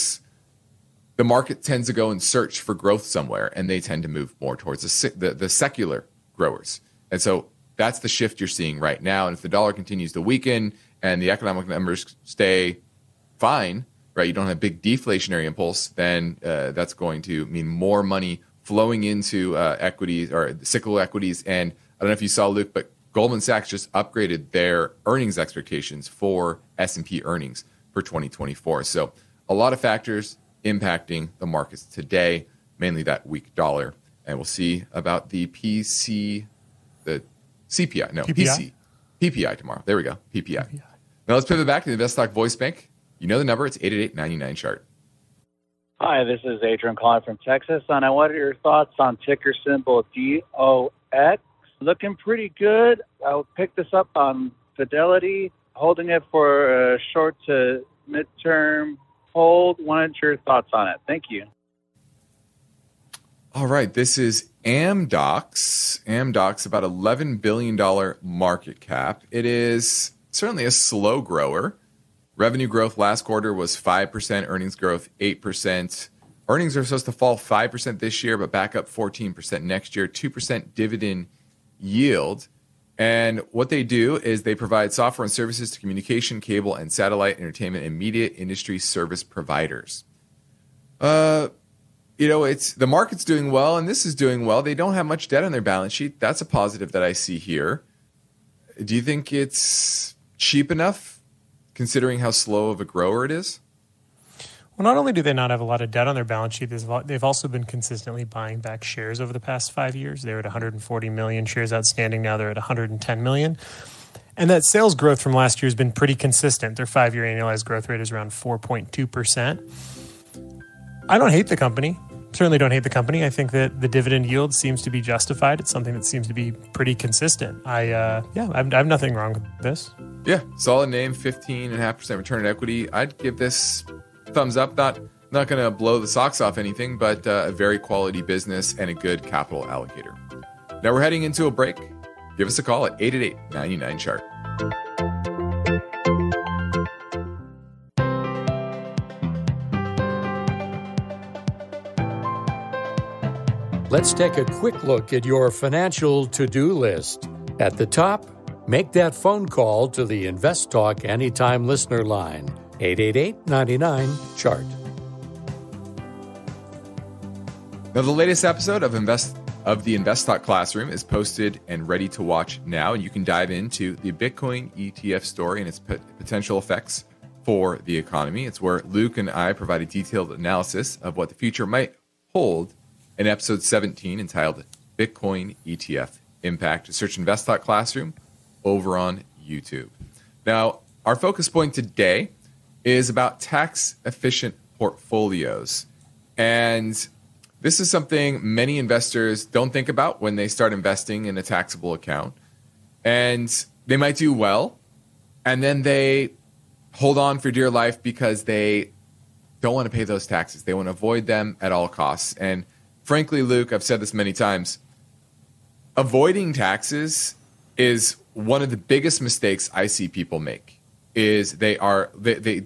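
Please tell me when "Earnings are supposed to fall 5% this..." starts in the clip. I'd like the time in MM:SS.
01:16.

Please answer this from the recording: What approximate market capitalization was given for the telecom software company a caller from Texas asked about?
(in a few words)
$11 billion.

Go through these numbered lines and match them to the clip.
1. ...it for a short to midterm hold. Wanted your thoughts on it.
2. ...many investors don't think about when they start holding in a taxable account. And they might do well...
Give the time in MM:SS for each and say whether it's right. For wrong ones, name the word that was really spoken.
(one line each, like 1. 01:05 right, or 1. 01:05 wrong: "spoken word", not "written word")
1. 00:56 right
2. 03:18 wrong: "investing", not "holding".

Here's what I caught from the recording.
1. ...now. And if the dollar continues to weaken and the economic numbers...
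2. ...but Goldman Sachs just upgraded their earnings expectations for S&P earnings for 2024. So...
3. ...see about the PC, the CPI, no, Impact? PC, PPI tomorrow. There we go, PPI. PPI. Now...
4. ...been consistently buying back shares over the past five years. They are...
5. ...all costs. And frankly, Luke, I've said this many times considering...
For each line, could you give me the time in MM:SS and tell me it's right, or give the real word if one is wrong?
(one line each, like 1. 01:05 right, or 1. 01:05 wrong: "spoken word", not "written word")
1. 00:09 right
2. 00:22 right
3. 00:34 wrong: "PPI", not "Impact"
4. 01:47 right
5. 03:31 wrong: "avoiding", not "considering".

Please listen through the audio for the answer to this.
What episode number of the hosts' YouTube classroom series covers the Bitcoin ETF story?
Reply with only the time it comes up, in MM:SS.
03:03.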